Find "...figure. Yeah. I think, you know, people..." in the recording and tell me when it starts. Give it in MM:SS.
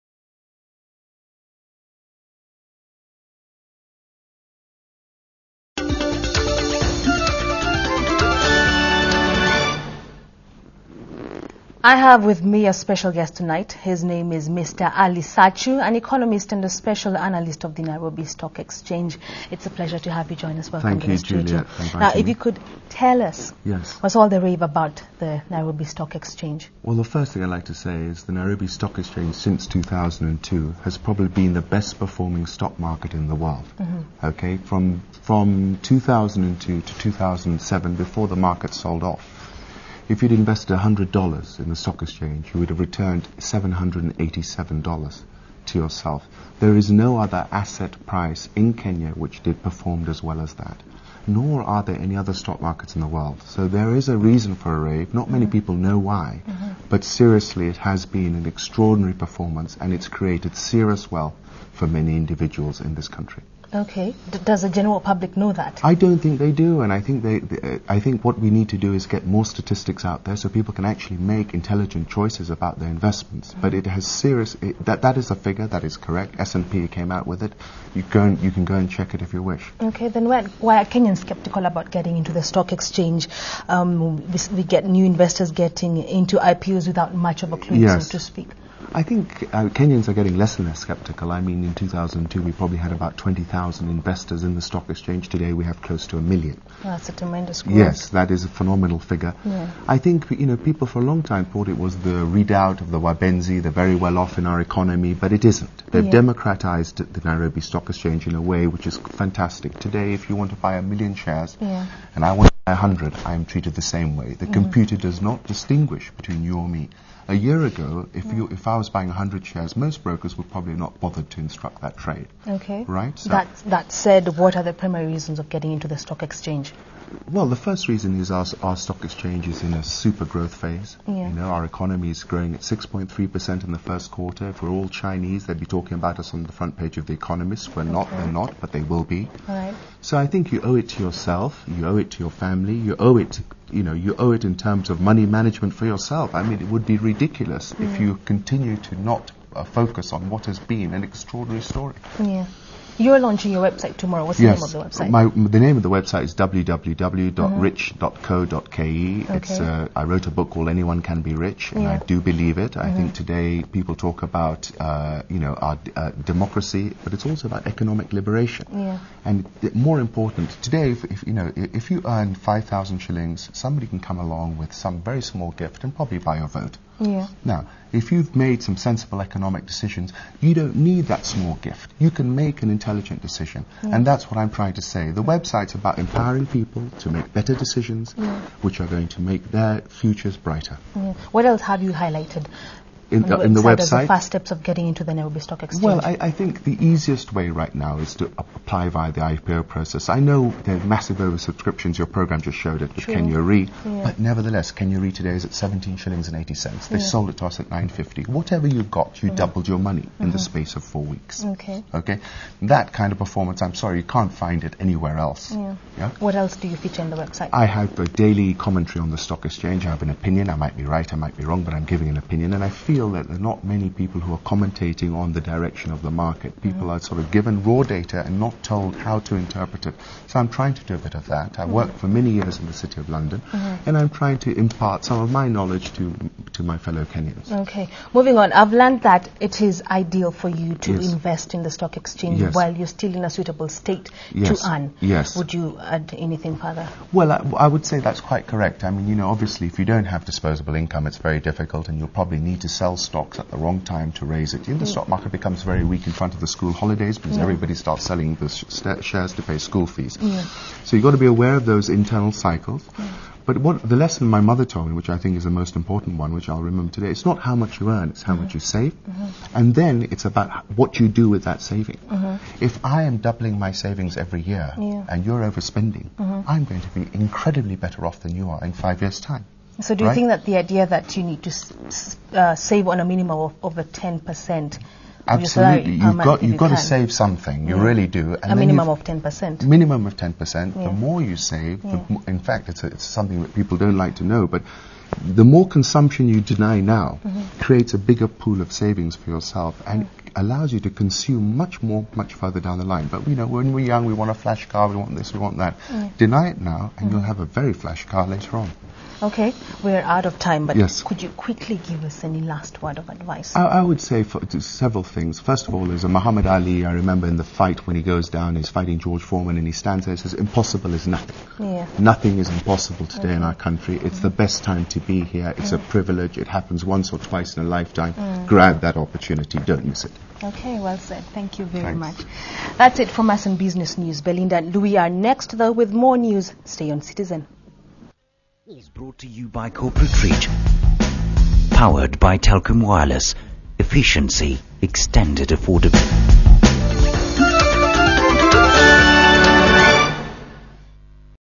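01:38.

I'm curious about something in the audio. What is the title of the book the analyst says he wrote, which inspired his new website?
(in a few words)
Anyone Can Be Rich.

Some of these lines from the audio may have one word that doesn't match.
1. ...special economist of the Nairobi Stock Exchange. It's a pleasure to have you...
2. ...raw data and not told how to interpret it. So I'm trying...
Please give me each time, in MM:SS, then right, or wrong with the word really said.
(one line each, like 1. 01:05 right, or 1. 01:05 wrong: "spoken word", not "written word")
1. 00:16 wrong: "analyst", not "economist"
2. 03:47 right.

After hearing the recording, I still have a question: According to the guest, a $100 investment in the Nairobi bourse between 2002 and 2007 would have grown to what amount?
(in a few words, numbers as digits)
$787.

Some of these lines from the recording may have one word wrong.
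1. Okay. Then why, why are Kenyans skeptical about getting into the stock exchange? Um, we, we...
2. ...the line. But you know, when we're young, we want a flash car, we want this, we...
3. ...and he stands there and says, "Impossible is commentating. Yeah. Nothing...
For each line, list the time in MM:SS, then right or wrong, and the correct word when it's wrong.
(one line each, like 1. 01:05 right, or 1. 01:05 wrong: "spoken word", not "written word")
1. 01:19 right
2. 05:02 right
3. 05:19 wrong: "nothing", not "commentating".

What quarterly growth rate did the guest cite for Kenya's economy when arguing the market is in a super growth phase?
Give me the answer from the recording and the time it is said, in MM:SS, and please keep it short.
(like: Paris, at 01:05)
6.3%, at 02:12.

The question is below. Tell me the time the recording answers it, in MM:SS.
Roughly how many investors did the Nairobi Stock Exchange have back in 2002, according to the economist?
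01:33.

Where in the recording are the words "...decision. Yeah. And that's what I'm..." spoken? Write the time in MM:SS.
03:03.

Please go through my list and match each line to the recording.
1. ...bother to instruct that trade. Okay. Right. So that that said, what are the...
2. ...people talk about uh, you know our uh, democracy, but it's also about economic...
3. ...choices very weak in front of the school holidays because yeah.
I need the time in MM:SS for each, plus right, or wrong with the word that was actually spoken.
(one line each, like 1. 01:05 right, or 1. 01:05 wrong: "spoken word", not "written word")
1. 02:00 right
2. 02:43 right
3. 04:15 wrong: "becomes", not "choices".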